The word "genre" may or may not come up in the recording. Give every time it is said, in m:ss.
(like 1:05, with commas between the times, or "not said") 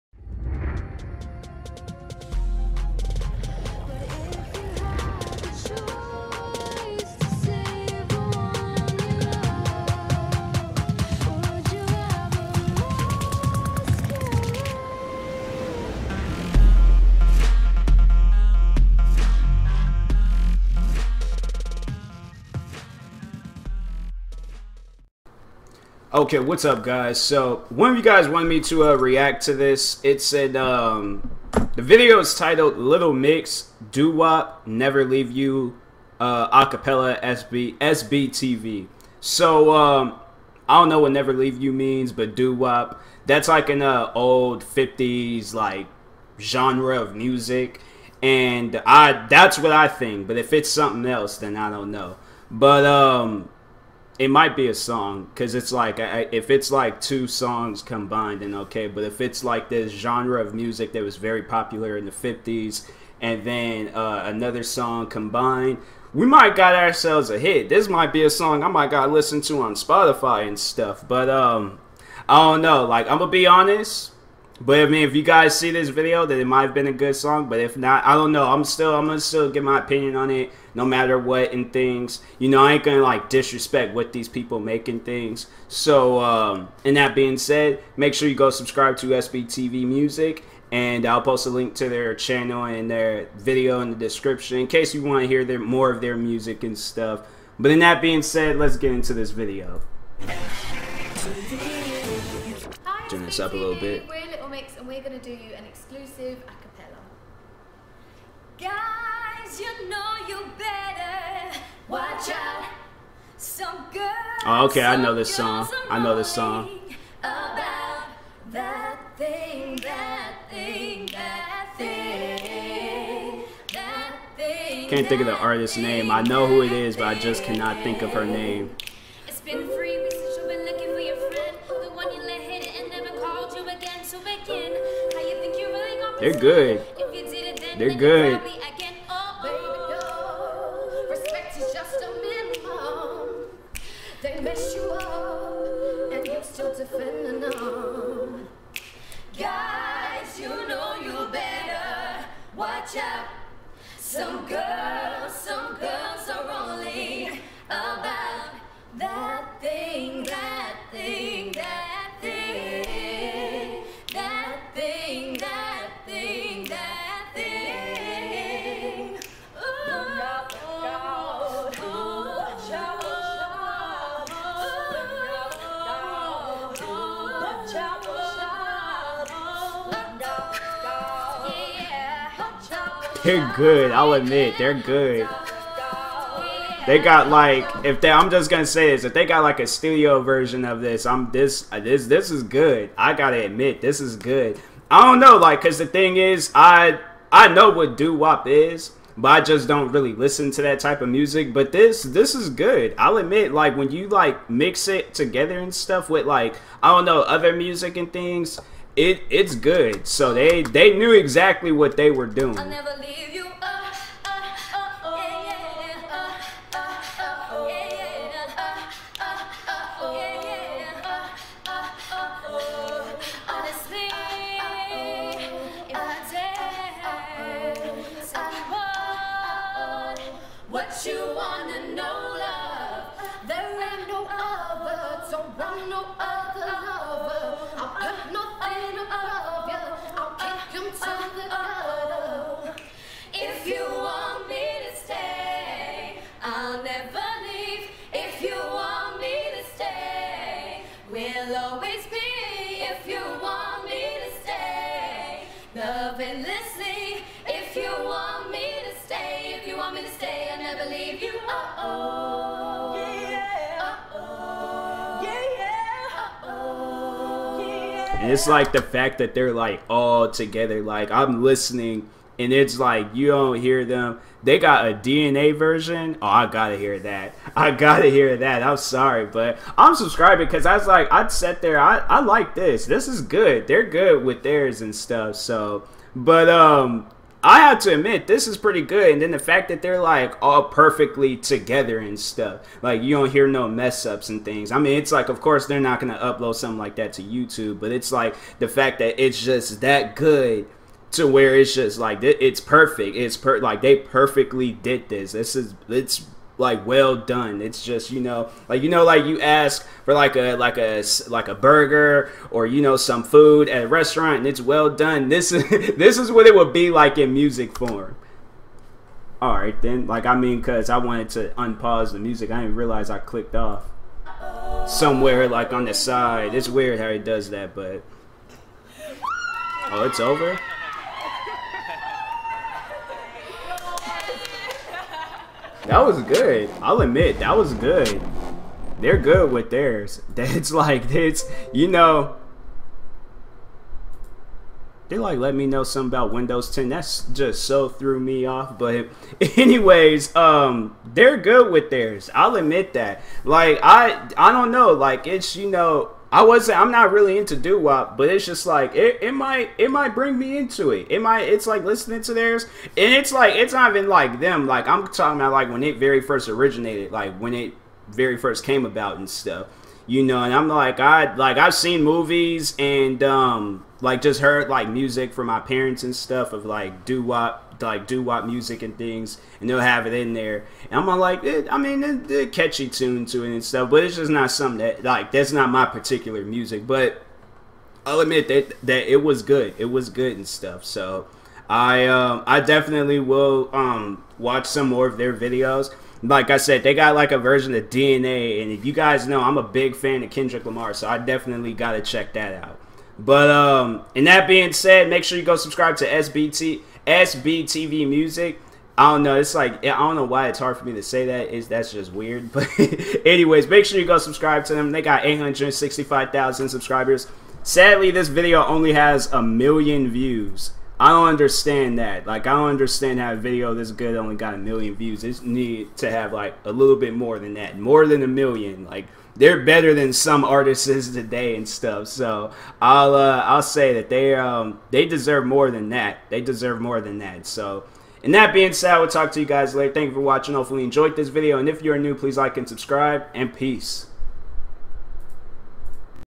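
0:46, 0:59.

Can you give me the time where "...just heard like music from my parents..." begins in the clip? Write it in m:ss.
6:14.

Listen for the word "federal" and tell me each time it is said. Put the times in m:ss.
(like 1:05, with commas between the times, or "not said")
not said.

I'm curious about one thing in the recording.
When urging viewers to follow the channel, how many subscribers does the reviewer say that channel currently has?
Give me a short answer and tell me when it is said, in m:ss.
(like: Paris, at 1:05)
865,000, at 6:55.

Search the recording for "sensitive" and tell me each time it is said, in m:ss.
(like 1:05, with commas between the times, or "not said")
not said.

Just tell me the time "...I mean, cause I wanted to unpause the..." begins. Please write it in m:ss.
5:20.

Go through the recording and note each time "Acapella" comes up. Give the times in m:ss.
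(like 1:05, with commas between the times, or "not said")
0:36.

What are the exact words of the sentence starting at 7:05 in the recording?
It need to have like a little bit more than that, more than a million.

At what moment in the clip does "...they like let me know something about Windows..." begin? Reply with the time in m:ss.
5:45.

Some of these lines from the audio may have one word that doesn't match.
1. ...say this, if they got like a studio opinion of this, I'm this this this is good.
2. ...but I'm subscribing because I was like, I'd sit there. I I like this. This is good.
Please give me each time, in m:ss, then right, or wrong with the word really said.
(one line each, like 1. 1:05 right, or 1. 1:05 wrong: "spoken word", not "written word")
1. 3:08 wrong: "version", not "opinion"
2. 4:39 right.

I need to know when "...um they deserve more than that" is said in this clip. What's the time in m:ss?
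7:14.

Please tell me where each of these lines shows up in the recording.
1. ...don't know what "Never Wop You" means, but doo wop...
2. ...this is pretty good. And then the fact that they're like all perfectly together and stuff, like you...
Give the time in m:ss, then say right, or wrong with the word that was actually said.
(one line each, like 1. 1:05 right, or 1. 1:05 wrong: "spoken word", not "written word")
1. 0:40 wrong: "Leave", not "Wop"
2. 4:48 right.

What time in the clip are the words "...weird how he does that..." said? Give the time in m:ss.
5:26.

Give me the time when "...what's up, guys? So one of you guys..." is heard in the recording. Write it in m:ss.
0:26.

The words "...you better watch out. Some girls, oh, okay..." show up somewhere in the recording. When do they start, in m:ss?
1:50.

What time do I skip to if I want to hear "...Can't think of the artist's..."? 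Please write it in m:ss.
2:04.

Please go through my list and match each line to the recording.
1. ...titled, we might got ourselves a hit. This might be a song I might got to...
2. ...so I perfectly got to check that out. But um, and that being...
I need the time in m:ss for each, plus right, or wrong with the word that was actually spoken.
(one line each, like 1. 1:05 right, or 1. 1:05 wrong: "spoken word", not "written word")
1. 1:05 wrong: "combined", not "titled"
2. 6:40 wrong: "definitely", not "perfectly".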